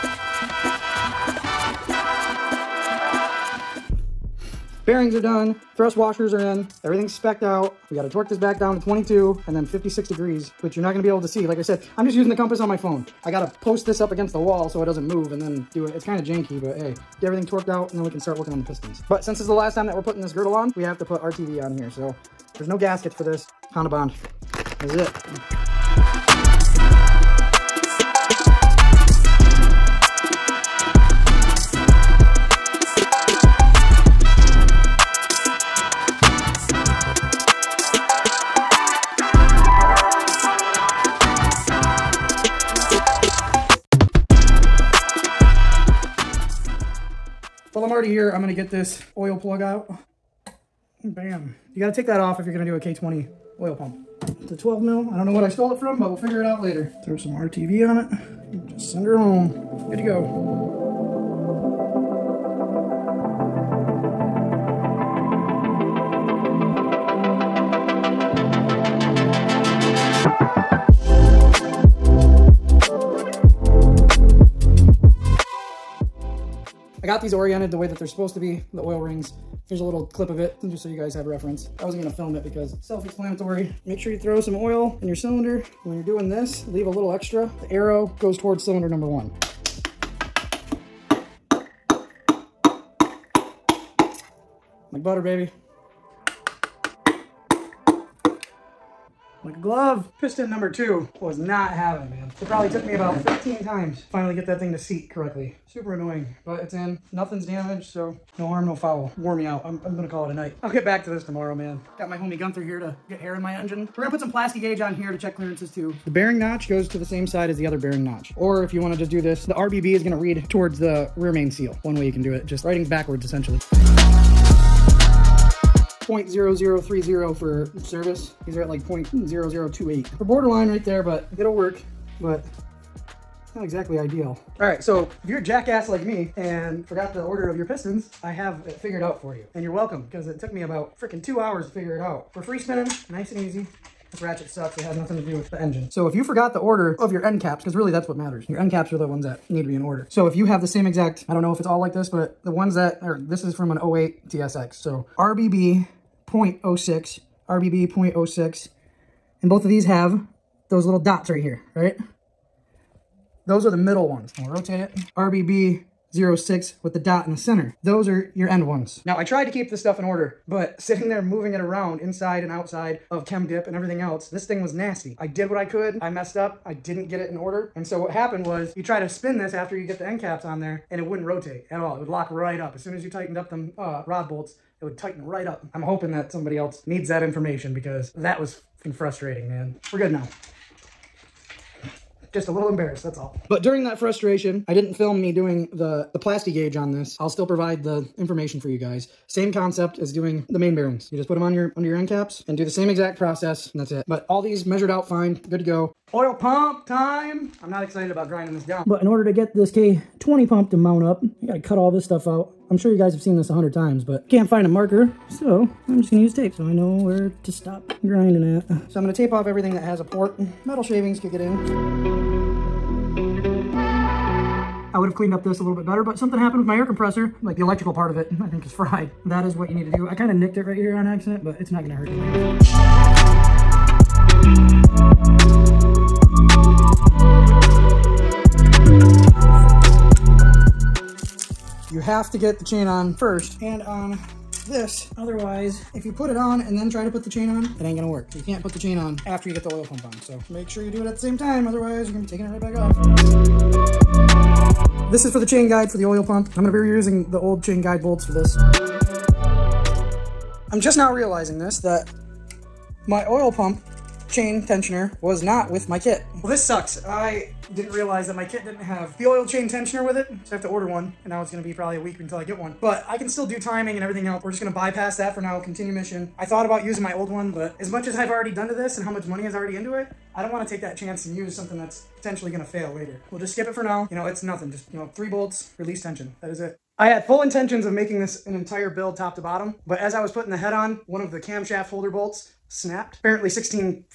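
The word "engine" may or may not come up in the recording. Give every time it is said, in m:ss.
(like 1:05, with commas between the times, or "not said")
1:53, 2:25.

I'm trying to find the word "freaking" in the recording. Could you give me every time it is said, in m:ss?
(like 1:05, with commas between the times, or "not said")
2:20.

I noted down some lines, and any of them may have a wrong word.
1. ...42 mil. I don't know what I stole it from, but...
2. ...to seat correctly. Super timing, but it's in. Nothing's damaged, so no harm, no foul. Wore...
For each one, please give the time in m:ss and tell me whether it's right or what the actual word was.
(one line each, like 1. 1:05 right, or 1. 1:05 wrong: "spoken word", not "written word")
1. 0:54 wrong: "12", not "42"
2. 1:44 wrong: "annoying", not "timing".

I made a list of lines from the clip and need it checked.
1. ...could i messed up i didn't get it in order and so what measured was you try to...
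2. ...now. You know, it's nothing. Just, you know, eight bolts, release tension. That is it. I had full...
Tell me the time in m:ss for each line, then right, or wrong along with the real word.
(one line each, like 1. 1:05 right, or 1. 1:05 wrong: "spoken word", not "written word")
1. 2:55 wrong: "happened", not "measured"
2. 4:43 wrong: "three", not "eight".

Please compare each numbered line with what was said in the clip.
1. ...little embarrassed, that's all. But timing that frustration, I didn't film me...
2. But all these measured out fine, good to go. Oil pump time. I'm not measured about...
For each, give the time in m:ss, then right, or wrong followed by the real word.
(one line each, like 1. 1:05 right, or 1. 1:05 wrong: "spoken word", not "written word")
1. 3:12 wrong: "during", not "timing"
2. 3:24 wrong: "excited", not "measured".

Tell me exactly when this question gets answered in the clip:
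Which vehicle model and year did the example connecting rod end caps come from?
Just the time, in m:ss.
2:33.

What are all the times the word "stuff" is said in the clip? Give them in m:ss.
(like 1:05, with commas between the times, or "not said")
2:49, 3:32.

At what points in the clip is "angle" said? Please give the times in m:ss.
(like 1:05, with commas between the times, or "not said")
not said.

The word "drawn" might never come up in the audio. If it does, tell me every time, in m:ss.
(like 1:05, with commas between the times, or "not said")
not said.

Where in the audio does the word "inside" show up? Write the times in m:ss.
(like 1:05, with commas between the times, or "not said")
2:51.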